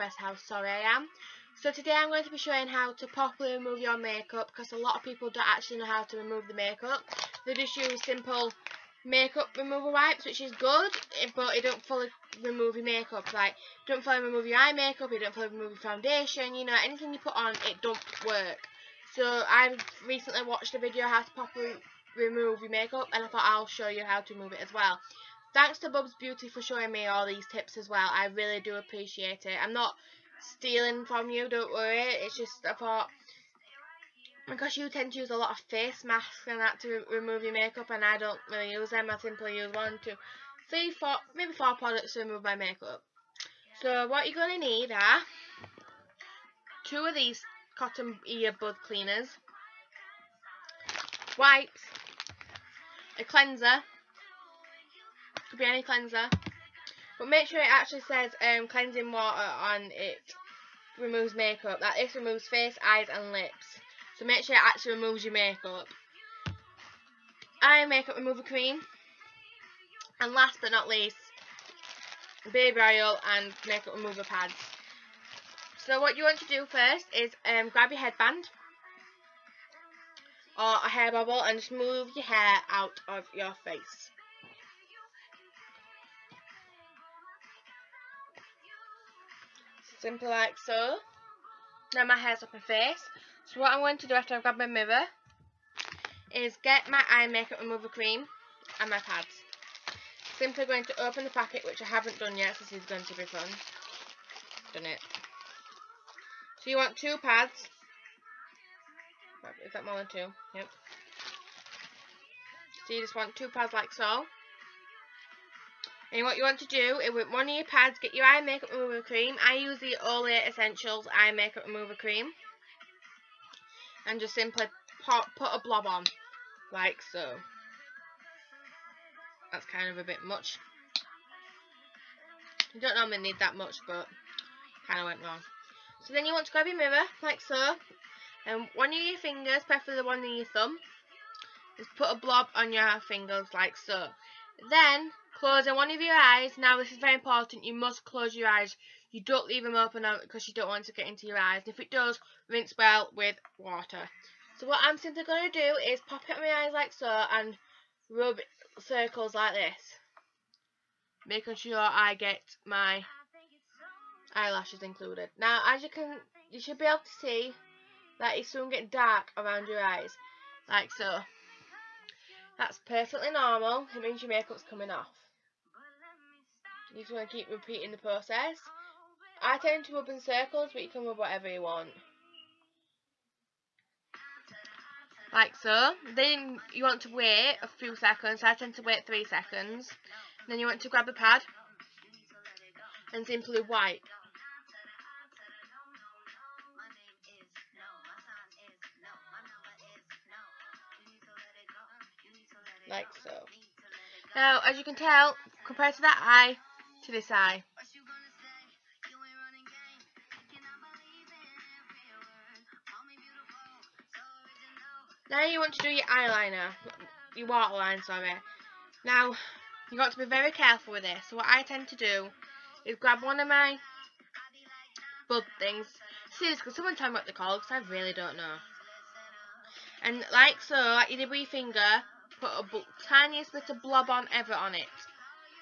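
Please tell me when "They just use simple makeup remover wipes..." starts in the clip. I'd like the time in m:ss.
0:07.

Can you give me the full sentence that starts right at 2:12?
You don't normally need that much, but kind of went wrong.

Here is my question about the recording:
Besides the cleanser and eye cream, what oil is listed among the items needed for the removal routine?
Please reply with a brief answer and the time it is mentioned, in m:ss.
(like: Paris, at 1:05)
Baby oil, at 1:12.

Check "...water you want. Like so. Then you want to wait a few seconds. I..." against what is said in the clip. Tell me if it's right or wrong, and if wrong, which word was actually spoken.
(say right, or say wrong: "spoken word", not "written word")
wrong: "whatever", not "water".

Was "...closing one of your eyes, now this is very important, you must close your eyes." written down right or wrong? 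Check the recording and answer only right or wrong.
right.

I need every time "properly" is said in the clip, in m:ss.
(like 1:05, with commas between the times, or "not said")
0:03, 0:21.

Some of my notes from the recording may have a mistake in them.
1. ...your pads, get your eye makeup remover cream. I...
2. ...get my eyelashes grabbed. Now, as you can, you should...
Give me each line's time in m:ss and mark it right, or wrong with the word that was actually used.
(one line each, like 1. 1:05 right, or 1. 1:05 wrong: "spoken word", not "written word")
1. 1:57 right
2. 2:42 wrong: "included", not "grabbed".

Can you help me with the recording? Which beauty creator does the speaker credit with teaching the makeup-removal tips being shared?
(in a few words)
Bubs Beauty.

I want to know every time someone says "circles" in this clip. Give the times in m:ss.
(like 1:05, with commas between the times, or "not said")
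2:38, 3:00.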